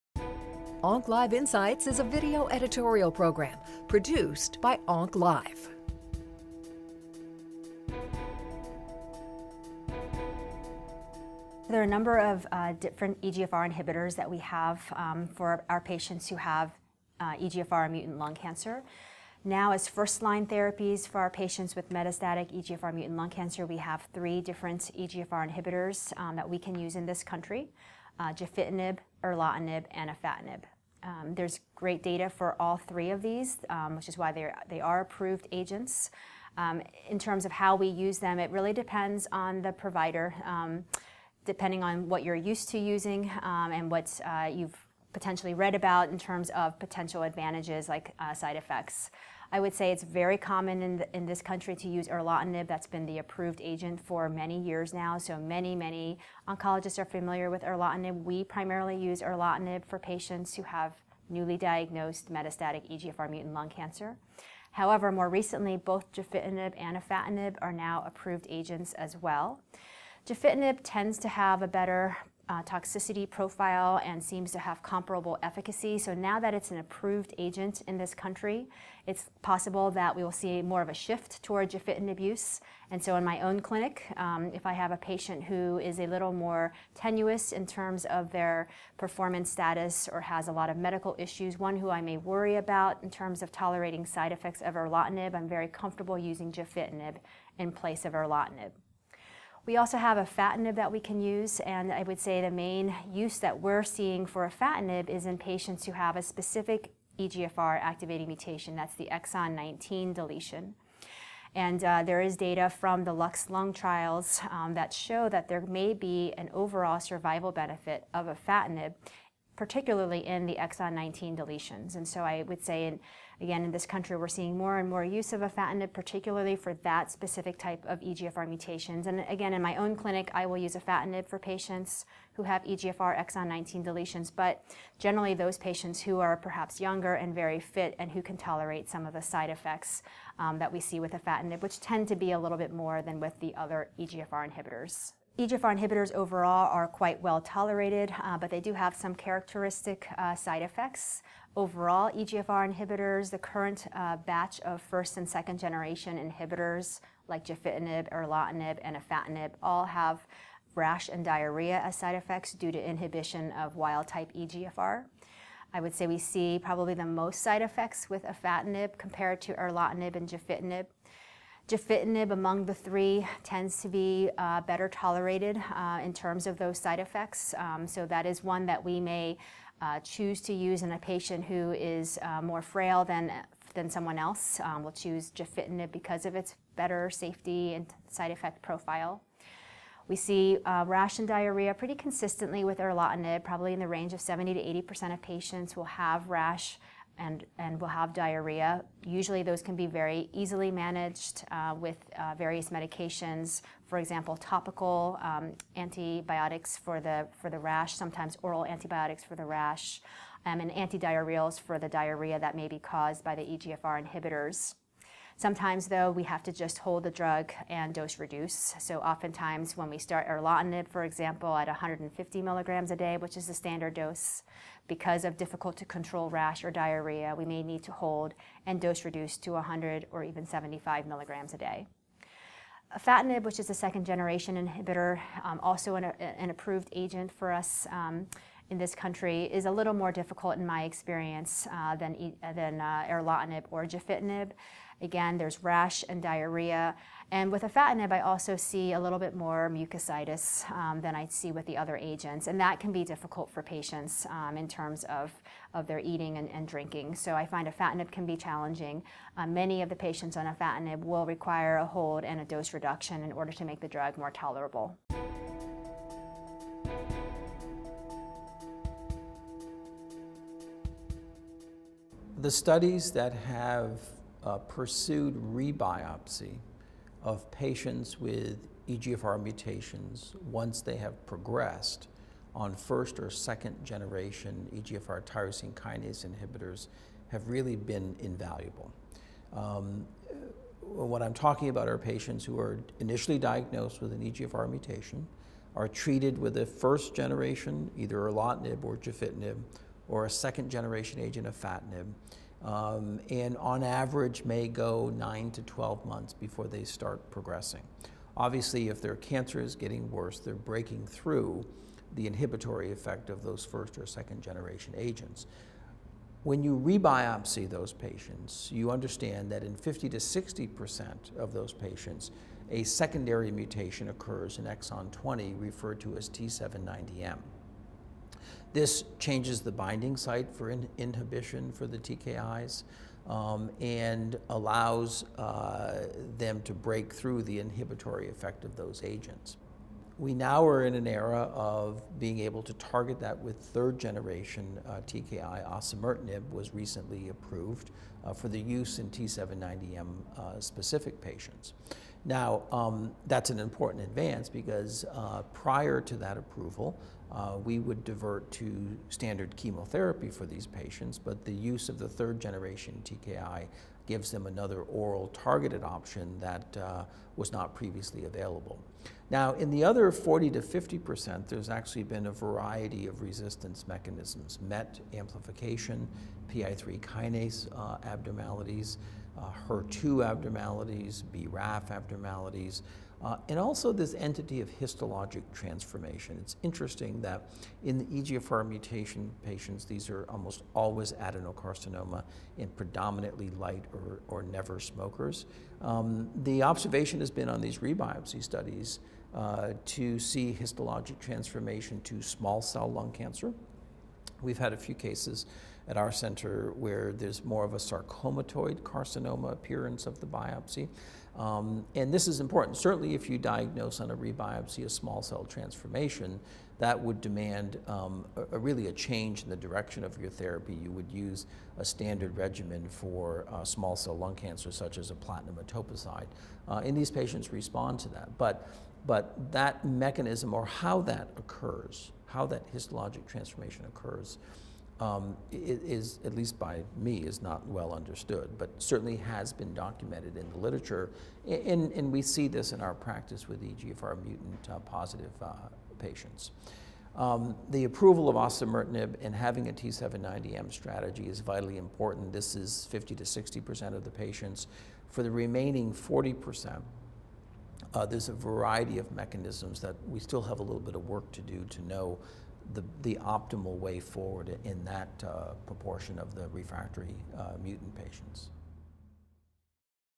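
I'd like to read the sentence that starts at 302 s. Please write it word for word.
Um, and on average may go 9 to 12 months before they start progressing.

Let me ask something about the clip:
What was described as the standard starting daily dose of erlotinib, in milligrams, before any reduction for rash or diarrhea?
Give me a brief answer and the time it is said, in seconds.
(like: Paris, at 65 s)
150 milligrams, at 221 s.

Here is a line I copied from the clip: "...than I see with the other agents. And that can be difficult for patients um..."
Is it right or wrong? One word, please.
right.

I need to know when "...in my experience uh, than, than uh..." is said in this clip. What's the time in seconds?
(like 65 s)
240 s.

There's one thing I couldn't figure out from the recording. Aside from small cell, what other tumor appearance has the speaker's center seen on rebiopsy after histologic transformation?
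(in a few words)
sarcomatoid carcinoma.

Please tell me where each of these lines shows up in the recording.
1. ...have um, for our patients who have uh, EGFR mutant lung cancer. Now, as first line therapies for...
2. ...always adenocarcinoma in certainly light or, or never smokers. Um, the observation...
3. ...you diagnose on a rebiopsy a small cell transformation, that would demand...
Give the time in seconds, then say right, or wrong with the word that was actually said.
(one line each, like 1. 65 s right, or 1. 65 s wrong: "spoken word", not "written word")
1. 14 s right
2. 390 s wrong: "predominantly", not "certainly"
3. 413 s right.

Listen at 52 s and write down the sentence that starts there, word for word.
That's been the approved agent for many years now.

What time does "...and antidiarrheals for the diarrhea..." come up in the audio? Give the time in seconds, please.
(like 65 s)
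210 s.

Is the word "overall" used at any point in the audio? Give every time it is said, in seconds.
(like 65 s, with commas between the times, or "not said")
116 s, 146 s, 151 s.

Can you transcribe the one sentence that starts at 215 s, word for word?
Sometimes, though, we have to just hold the drug and dose reduce.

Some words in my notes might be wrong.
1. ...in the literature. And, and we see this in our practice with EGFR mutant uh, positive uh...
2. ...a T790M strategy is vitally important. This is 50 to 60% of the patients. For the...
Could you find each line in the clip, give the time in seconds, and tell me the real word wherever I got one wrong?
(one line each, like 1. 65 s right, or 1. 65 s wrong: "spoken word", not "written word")
1. 440 s right
2. 449 s right.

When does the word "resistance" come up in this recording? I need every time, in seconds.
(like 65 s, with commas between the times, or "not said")
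373 s.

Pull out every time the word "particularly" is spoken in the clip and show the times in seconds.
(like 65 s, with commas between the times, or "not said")
119 s, 125 s.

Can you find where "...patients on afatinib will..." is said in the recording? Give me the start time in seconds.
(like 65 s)
259 s.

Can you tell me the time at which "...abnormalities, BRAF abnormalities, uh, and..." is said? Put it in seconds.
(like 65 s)
380 s.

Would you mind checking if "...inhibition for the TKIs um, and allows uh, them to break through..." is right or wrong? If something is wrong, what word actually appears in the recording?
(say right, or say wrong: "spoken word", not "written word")
right.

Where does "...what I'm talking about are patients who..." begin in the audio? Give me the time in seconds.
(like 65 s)
291 s.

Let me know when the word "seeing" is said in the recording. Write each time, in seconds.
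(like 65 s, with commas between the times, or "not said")
103 s, 124 s.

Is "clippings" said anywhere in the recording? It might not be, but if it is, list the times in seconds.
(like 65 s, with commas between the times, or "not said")
not said.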